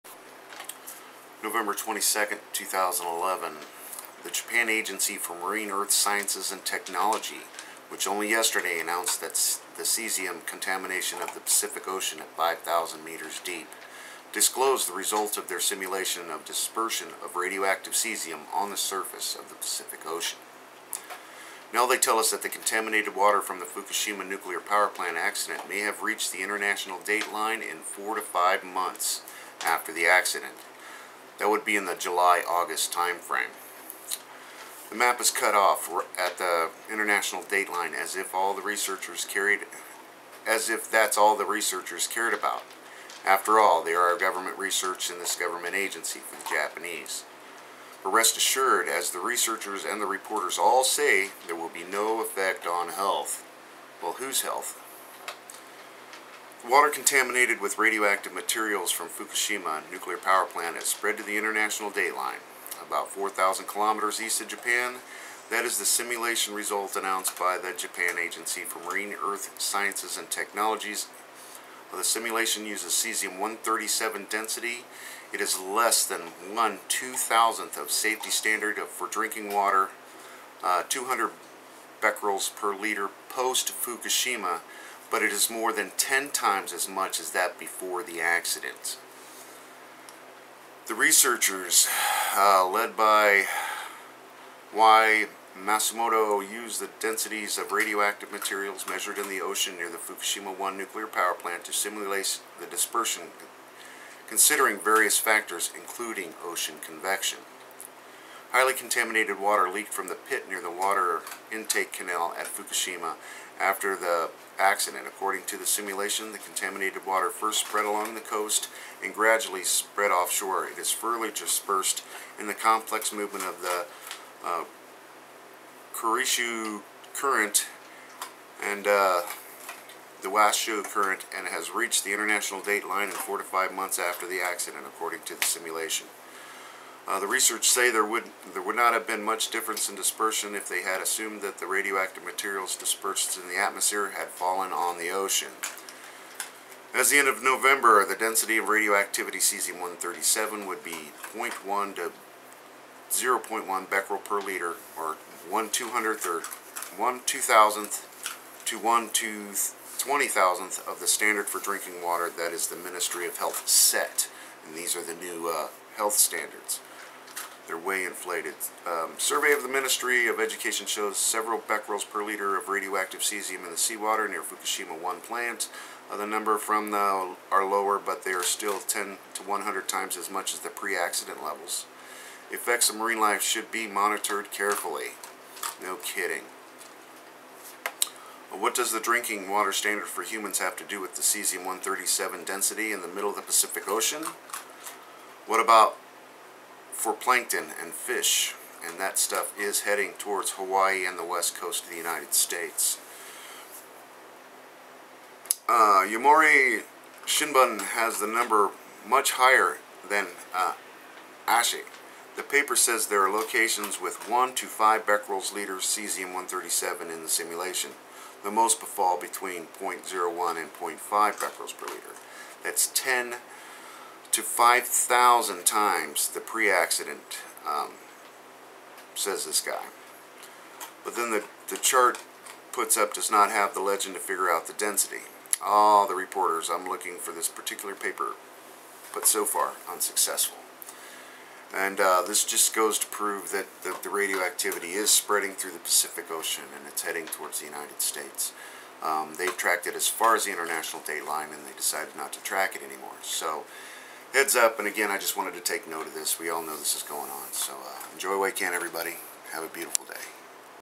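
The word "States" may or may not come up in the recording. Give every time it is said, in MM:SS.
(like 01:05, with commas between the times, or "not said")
03:22, 04:08.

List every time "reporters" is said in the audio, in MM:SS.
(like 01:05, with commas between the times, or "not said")
00:50, 03:56.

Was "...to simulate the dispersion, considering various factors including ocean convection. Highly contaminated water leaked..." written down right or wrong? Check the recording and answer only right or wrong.
right.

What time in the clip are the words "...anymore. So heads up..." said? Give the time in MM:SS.
04:12.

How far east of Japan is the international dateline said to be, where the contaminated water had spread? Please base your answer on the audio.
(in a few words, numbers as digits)
4,000 kilometers.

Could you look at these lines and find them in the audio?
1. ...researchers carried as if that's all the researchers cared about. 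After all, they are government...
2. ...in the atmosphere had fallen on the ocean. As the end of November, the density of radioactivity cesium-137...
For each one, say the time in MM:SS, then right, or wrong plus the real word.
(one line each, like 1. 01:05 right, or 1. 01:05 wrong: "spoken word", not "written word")
1. 00:38 right
2. 02:23 right.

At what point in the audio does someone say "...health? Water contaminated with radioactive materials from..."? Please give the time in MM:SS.
00:54.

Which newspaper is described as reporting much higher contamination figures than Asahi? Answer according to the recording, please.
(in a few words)
Yomiuri Shinbun.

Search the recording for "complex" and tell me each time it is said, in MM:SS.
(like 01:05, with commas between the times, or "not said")
02:02.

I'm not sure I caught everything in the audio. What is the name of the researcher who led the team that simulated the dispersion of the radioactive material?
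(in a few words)
Y. Masumoto.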